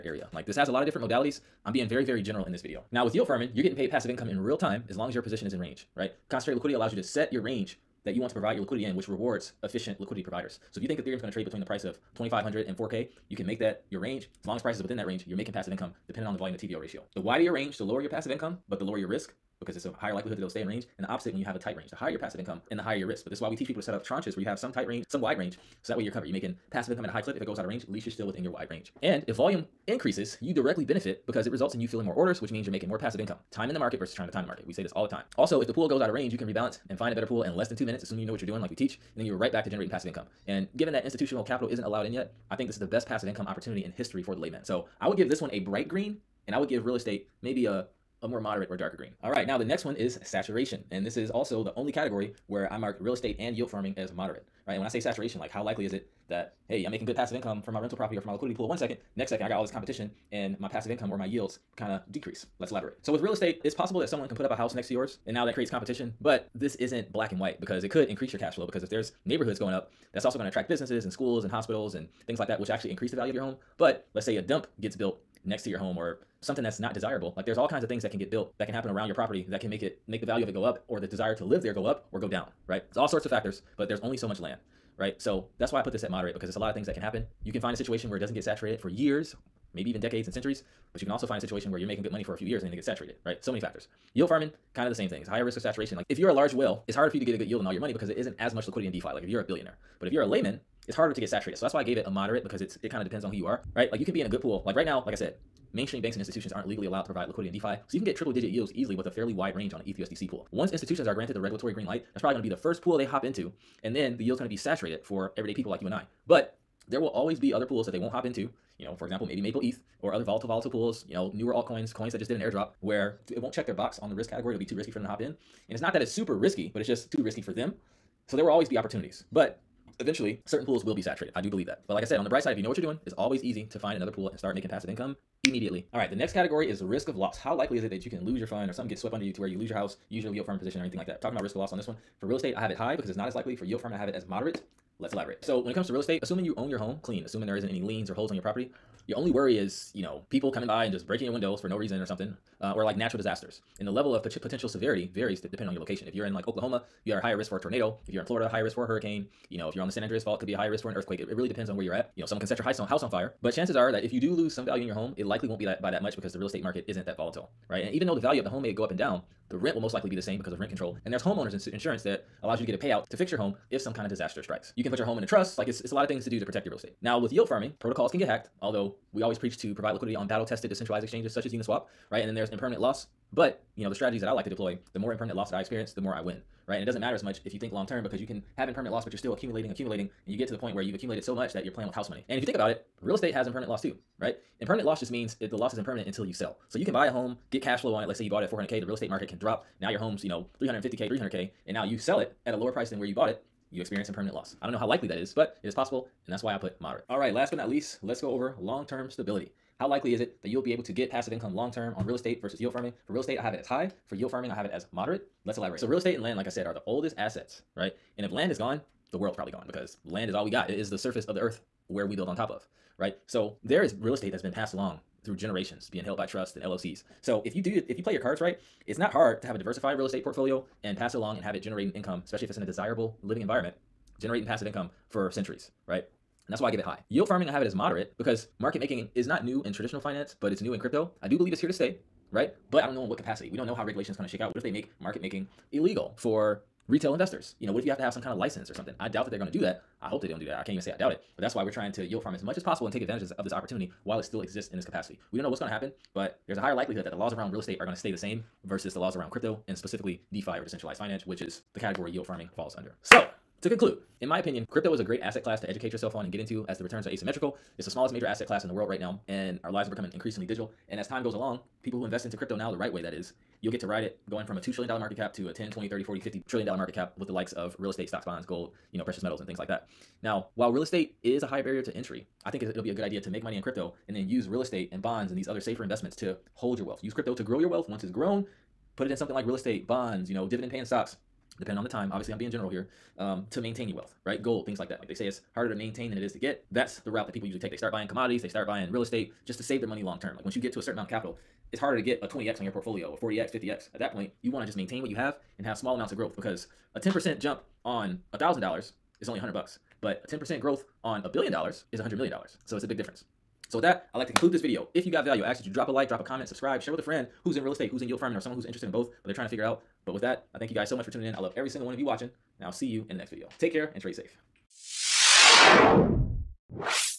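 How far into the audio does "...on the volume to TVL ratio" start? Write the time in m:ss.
0:16.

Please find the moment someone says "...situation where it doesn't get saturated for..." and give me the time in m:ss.
1:27.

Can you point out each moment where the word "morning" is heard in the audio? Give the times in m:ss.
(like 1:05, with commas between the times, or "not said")
not said.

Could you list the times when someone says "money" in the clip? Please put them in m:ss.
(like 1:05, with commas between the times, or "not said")
1:32, 1:37, 3:12, 4:43, 4:59.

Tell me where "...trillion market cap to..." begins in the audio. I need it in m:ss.
4:34.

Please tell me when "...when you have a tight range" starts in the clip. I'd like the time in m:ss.
0:21.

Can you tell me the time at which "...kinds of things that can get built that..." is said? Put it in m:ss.
1:17.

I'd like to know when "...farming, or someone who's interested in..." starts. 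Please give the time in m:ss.
5:18.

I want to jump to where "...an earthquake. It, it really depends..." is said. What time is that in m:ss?
2:40.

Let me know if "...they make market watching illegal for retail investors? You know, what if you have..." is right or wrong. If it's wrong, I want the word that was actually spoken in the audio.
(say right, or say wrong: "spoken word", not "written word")
wrong: "making", not "watching".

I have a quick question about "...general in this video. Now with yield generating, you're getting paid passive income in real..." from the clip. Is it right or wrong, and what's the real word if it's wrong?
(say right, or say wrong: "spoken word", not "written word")
wrong: "farming", not "generating".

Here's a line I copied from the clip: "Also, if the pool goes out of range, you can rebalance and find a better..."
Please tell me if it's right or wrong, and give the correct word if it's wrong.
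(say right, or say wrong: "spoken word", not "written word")
right.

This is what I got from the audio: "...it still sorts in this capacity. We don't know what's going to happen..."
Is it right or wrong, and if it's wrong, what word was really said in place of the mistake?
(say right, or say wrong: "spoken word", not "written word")
wrong: "exists", not "sorts".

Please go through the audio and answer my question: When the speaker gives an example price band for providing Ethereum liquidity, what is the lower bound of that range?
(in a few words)
2,500.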